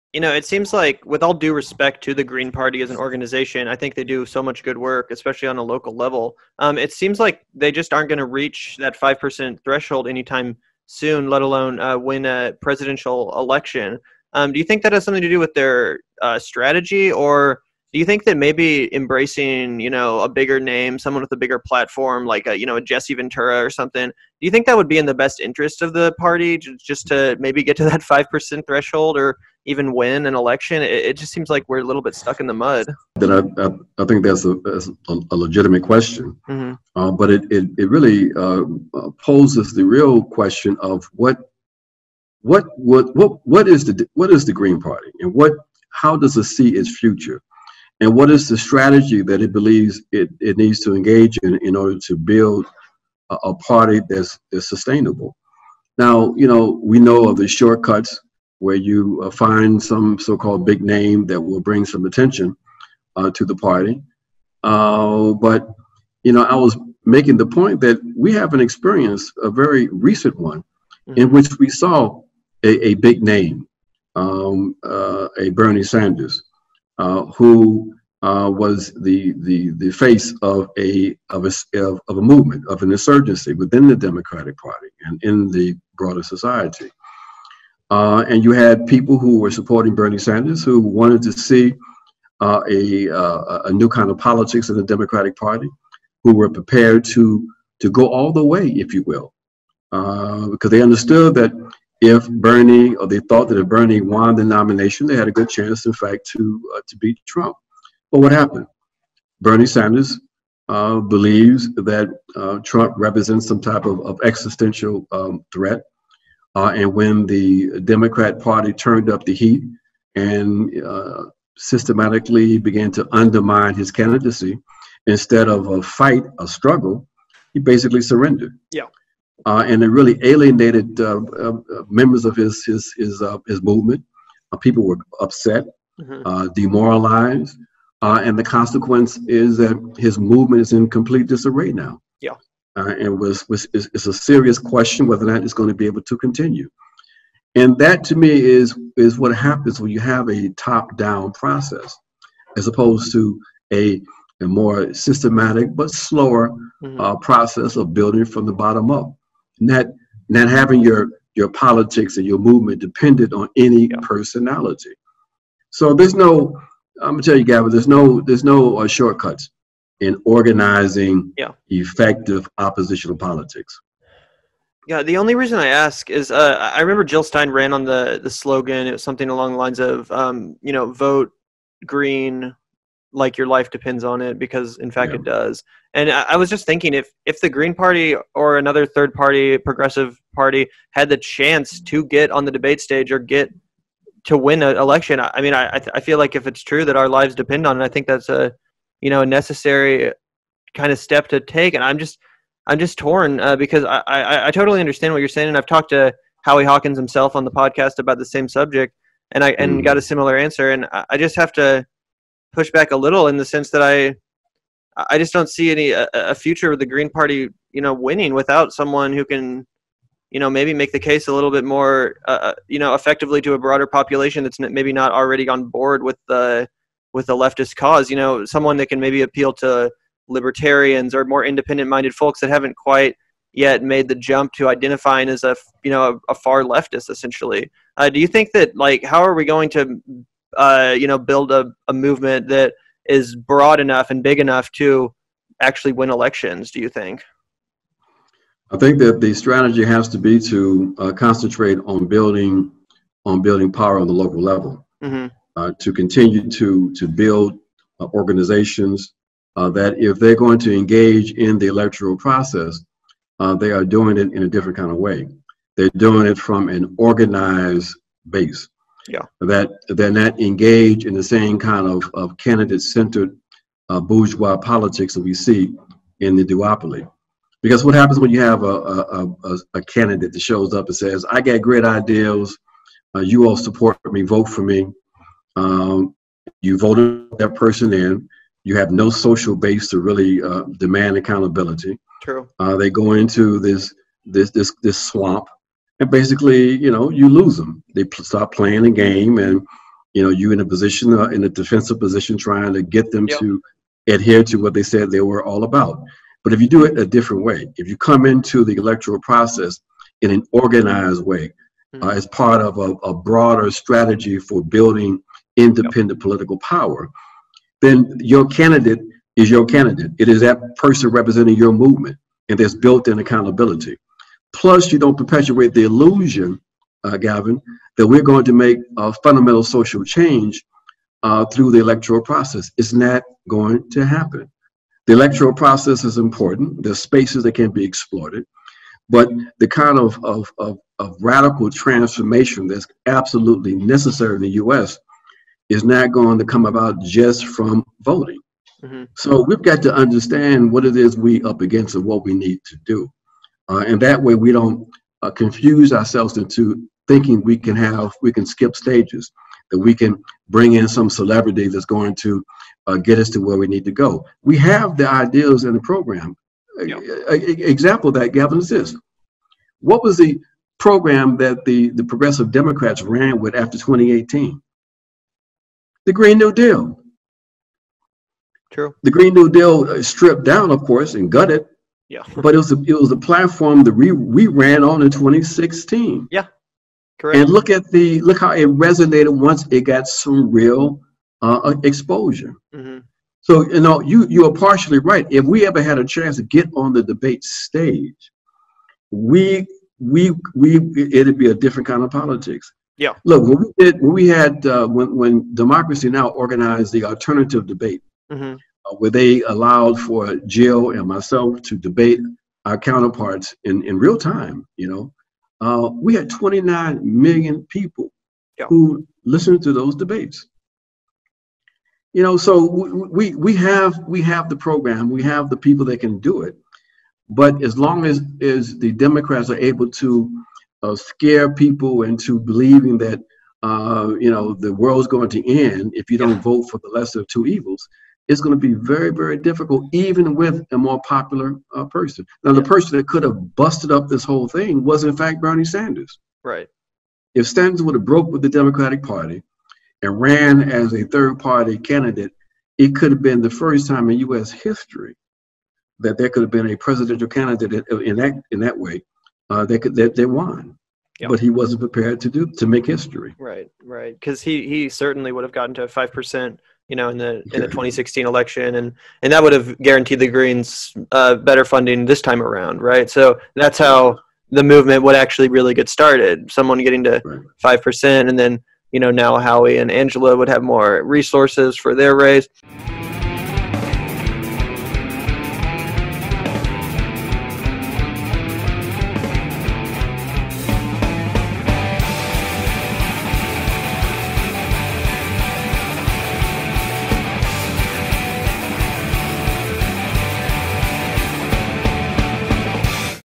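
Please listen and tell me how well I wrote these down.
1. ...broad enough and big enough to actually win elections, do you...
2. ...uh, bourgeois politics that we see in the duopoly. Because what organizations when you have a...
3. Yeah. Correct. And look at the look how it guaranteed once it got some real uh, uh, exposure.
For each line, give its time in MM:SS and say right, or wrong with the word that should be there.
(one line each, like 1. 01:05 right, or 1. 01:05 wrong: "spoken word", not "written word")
1. 04:03 right
2. 04:33 wrong: "happens", not "organizations"
3. 06:26 wrong: "resonated", not "guaranteed".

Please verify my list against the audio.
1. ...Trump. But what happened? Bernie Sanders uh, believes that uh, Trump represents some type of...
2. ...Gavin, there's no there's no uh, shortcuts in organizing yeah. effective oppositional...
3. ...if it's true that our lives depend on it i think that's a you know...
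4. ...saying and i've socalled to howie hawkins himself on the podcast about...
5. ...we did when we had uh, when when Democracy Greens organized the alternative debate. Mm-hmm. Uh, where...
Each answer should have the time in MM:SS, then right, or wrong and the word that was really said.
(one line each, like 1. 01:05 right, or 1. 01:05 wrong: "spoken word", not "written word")
1. 01:47 right
2. 02:47 right
3. 03:16 right
4. 03:25 wrong: "talked", not "socalled"
5. 06:43 wrong: "Now", not "Greens".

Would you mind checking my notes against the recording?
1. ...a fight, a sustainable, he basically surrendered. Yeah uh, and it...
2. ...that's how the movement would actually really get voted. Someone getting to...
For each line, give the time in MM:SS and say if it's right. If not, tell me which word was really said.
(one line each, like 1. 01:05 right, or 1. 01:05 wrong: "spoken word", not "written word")
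1. 02:05 wrong: "struggle", not "sustainable"
2. 07:53 wrong: "started", not "voted".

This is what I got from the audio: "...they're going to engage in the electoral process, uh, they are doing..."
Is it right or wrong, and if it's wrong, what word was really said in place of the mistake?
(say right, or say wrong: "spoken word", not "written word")
right.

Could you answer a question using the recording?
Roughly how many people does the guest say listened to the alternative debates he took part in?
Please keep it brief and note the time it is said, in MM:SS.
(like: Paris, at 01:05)
29 million, at 06:56.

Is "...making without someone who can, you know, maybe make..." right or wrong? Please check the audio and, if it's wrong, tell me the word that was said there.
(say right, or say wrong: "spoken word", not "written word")
wrong: "winning", not "making".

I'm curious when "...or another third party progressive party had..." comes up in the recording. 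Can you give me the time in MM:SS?
03:08.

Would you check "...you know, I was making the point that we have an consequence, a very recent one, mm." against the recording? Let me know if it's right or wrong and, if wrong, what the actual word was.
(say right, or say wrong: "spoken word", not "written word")
wrong: "experience", not "consequence".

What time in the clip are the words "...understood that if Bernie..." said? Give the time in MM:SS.
01:40.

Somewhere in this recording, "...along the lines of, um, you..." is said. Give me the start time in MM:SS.
02:59.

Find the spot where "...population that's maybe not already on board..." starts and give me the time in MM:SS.
03:43.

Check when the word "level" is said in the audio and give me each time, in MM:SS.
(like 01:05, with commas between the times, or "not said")
00:05, 04:14.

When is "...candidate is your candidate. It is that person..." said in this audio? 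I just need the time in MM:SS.
05:18.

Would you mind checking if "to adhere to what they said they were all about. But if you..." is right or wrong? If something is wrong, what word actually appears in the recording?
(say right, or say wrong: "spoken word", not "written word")
right.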